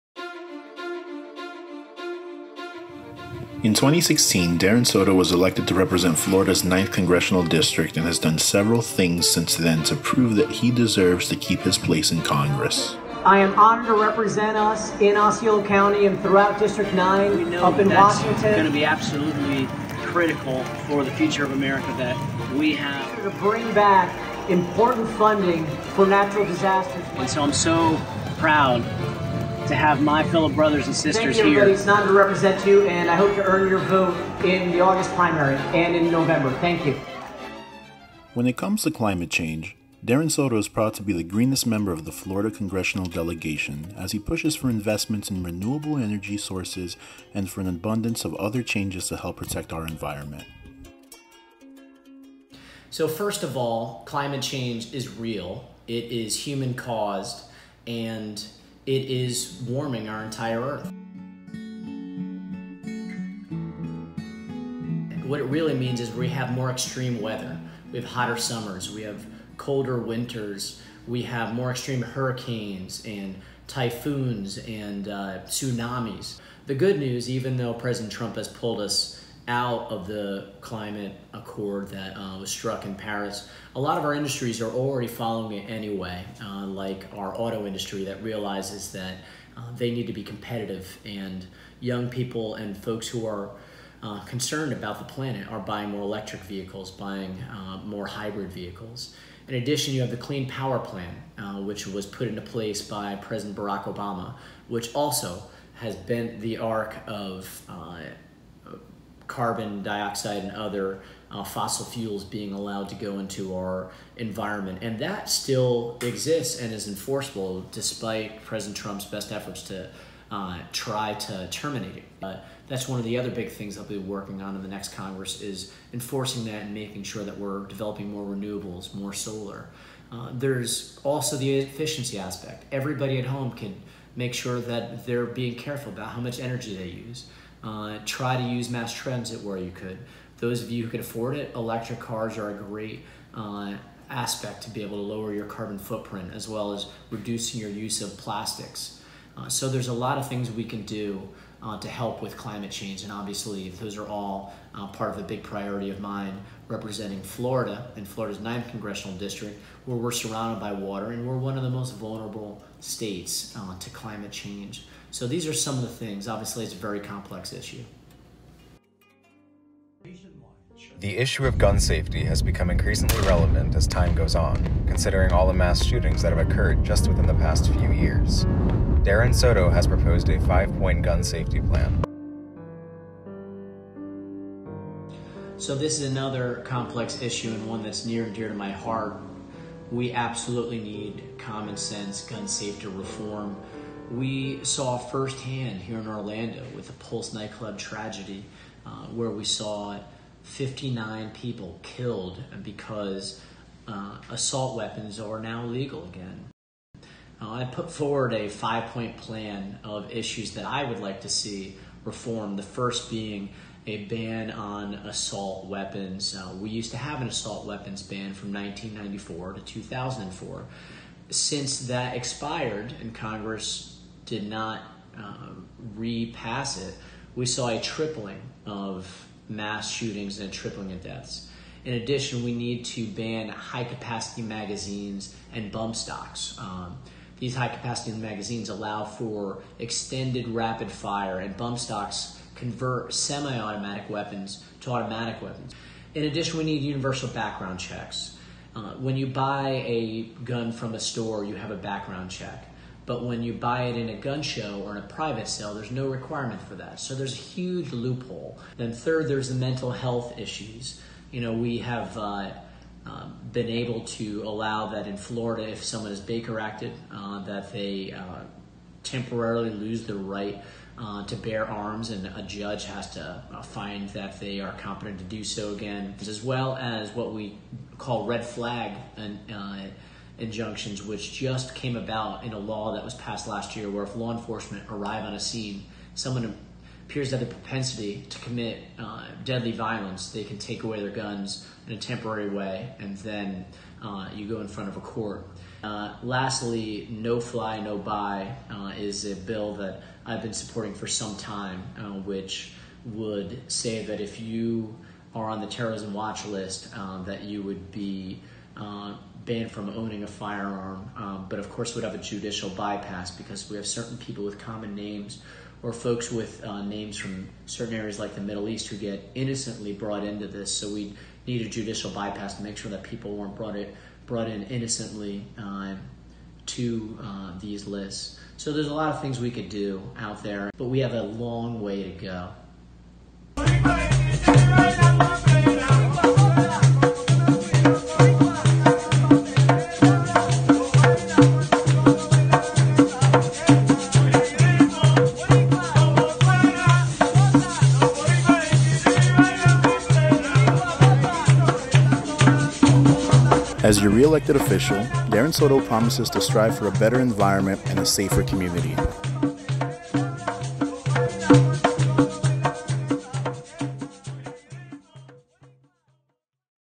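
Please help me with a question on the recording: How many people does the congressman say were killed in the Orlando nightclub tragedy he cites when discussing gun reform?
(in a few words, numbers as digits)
59.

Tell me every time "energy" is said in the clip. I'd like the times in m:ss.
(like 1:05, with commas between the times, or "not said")
0:45, 2:16.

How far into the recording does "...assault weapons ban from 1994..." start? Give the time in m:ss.
3:37.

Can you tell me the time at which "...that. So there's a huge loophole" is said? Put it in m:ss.
4:16.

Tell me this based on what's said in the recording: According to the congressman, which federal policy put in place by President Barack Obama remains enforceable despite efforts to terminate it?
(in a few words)
Clean Power Plan.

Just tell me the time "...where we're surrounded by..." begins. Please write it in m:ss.
2:39.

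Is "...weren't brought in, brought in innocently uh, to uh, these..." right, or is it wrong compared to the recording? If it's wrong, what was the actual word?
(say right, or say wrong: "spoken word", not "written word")
right.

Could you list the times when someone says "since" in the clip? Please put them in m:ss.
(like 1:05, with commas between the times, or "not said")
0:09, 3:41.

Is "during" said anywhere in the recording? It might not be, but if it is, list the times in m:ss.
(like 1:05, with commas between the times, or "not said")
not said.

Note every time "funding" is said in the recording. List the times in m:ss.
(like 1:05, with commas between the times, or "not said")
0:25.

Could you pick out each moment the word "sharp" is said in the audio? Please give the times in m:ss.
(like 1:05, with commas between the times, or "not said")
not said.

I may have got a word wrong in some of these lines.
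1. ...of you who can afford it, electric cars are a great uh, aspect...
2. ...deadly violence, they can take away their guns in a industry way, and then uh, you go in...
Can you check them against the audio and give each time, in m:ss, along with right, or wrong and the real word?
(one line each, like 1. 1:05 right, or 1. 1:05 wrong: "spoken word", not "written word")
1. 2:20 right
2. 4:49 wrong: "temporary", not "industry".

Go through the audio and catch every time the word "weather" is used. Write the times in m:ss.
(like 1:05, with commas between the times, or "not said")
1:07.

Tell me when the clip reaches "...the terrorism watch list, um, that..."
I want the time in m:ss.
5:05.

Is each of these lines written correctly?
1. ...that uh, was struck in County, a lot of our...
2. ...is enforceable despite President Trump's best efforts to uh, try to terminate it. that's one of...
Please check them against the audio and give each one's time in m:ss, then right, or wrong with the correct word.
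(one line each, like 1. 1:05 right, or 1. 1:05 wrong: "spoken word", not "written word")
1. 1:21 wrong: "Paris", not "County"
2. 1:56 right.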